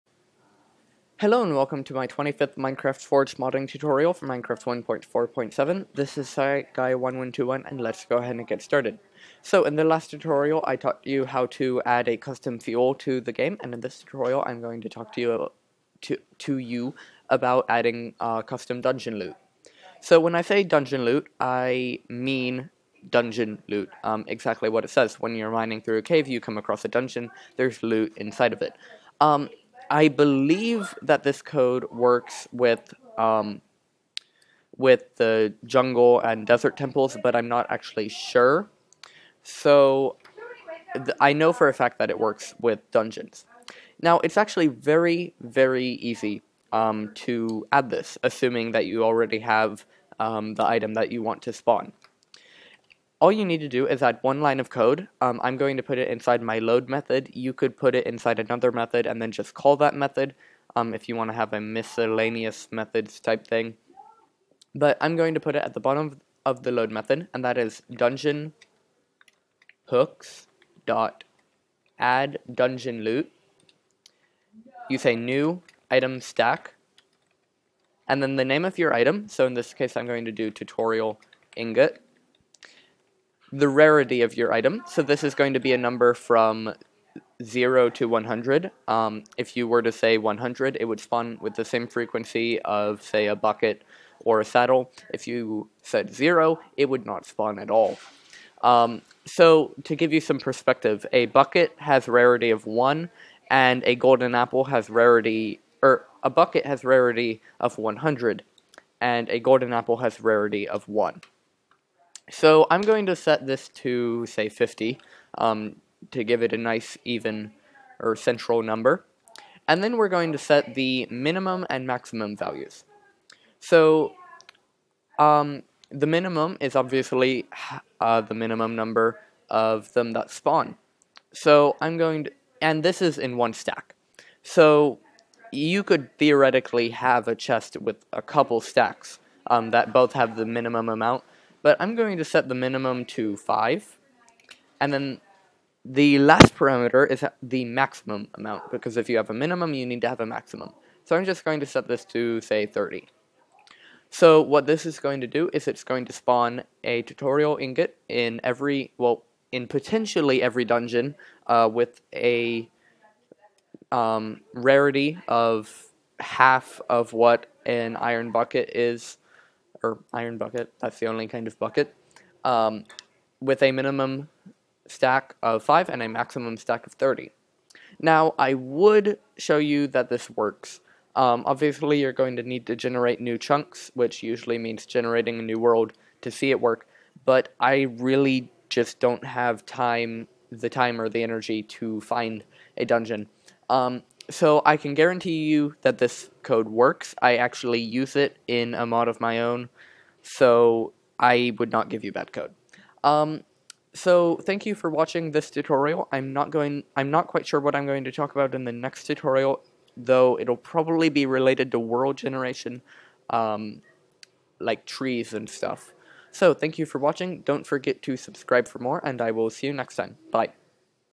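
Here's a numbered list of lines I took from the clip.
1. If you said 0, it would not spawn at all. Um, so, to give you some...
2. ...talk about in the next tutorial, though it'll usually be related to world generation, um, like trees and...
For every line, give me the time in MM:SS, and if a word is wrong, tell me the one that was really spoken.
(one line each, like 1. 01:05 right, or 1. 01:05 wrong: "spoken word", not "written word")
1. 01:35 right
2. 03:28 wrong: "probably", not "usually".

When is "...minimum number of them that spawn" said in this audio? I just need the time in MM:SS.
02:08.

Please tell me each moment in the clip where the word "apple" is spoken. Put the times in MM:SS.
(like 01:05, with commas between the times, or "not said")
01:44, 01:49.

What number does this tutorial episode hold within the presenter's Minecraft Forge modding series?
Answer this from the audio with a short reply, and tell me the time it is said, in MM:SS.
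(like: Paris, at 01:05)
25th, at 00:02.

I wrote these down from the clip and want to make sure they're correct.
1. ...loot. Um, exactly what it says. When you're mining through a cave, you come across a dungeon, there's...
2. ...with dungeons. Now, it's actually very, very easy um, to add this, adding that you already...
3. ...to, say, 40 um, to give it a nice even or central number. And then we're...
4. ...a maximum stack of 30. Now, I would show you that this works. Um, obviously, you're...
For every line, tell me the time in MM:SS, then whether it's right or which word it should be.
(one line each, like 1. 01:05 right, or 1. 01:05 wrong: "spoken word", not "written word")
1. 00:23 right
2. 00:42 wrong: "assuming", not "adding"
3. 01:53 wrong: "50", not "40"
4. 02:56 right.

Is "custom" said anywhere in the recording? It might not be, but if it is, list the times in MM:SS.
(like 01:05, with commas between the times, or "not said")
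00:12, 00:18.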